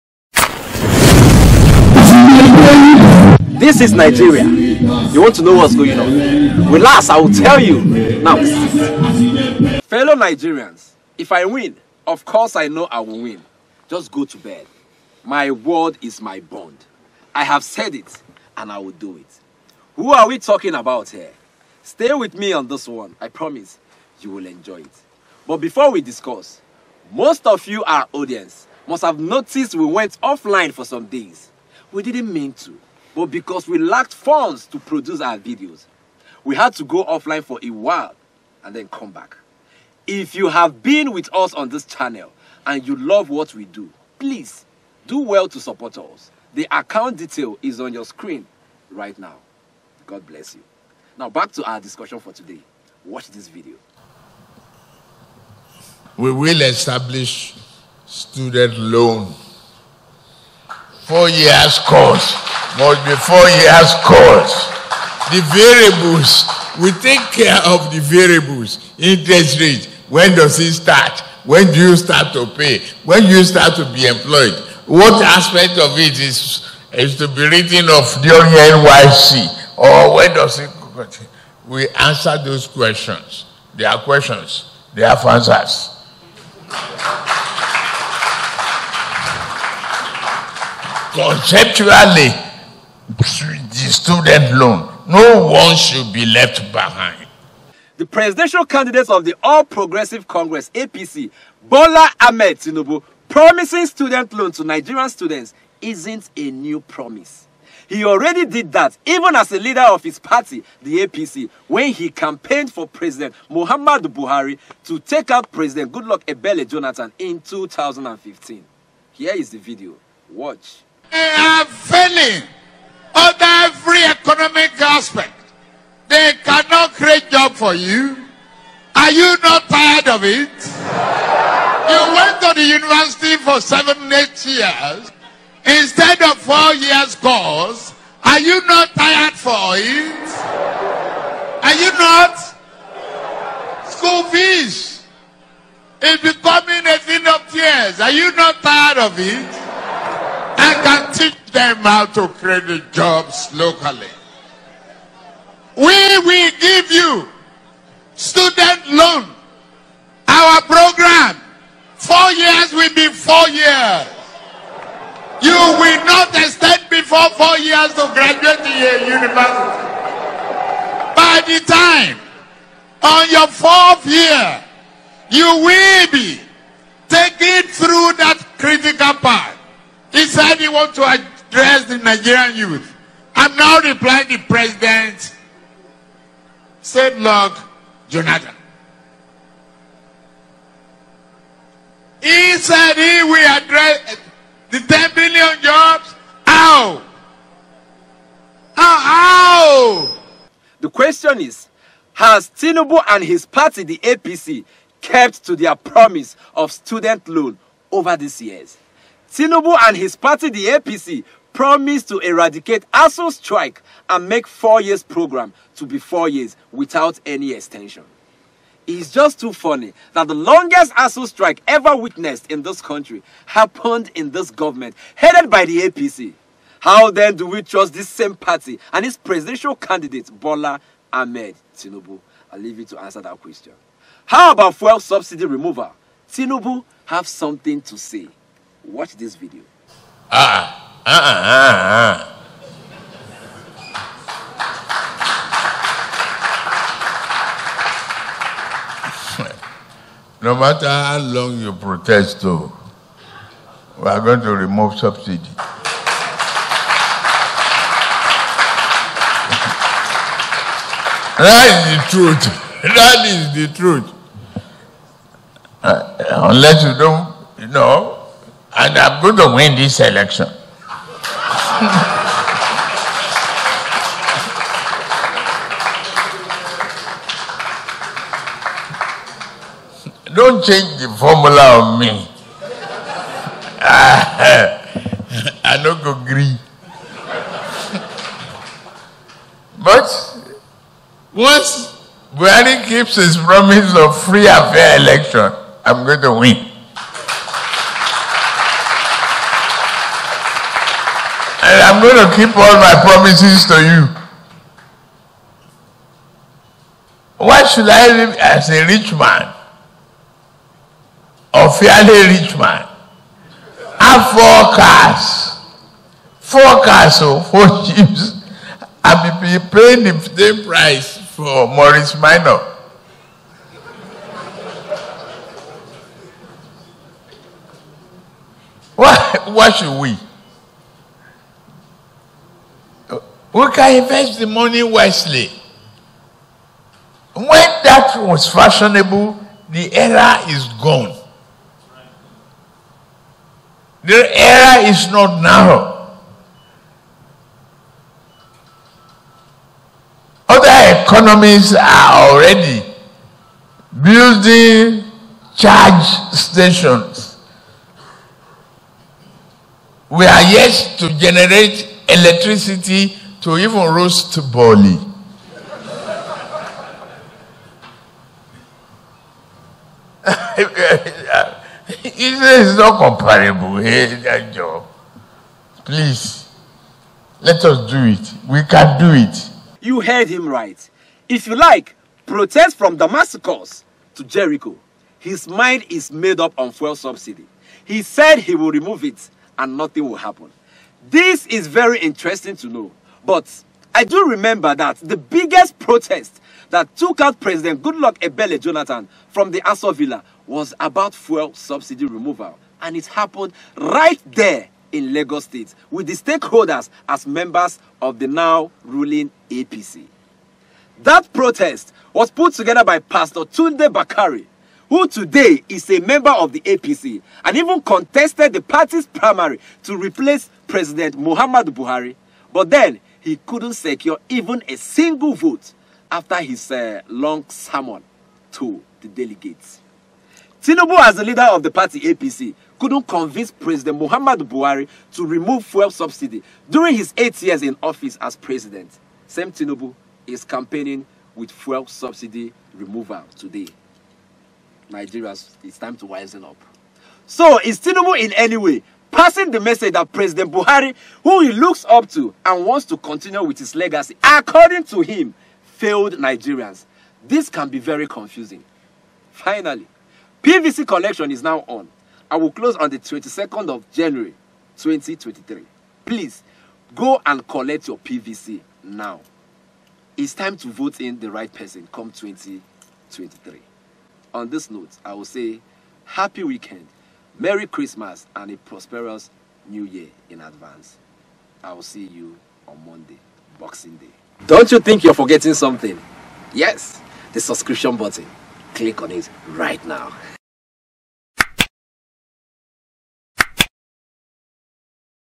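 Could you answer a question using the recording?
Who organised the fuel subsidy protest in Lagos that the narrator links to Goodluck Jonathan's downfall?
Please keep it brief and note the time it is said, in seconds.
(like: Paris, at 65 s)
Pastor Tunde Bakare, at 412 s.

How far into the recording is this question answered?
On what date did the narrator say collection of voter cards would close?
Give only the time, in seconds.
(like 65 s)
462 s.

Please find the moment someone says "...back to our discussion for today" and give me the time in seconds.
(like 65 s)
51 s.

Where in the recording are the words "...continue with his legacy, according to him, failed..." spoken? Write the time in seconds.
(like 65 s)
452 s.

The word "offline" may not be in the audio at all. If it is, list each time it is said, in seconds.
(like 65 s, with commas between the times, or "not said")
30 s, 37 s.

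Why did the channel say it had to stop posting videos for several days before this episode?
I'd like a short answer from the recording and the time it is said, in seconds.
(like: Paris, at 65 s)
lacked funds, at 33 s.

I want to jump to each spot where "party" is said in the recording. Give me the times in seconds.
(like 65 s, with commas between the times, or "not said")
110 s, 203 s, 210 s, 228 s, 418 s, 431 s.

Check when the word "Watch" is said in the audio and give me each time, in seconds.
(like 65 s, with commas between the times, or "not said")
53 s, 120 s, 238 s.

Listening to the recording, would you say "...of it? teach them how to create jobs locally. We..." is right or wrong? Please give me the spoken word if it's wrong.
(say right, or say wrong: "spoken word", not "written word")
right.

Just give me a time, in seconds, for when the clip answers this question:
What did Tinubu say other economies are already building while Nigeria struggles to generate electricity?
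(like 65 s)
355 s.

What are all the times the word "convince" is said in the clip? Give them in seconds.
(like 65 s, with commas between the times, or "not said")
433 s.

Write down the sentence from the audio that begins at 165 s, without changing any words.
You will not extend before four years to graduate a university.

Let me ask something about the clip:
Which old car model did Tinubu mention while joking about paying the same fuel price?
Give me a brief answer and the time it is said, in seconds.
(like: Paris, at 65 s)
Morris Minor, at 321 s.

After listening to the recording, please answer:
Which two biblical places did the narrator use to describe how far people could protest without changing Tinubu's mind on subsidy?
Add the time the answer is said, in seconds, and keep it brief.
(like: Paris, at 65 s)
Damascus to Jericho, at 382 s.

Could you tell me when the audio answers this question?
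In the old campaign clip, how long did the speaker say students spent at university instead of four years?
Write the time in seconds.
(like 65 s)
133 s.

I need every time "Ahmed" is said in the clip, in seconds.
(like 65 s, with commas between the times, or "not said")
102 s, 231 s.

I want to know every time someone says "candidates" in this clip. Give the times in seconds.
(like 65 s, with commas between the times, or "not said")
98 s, 229 s.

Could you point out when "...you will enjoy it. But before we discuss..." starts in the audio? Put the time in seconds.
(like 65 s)
24 s.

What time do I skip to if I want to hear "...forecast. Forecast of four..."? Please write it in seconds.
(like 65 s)
314 s.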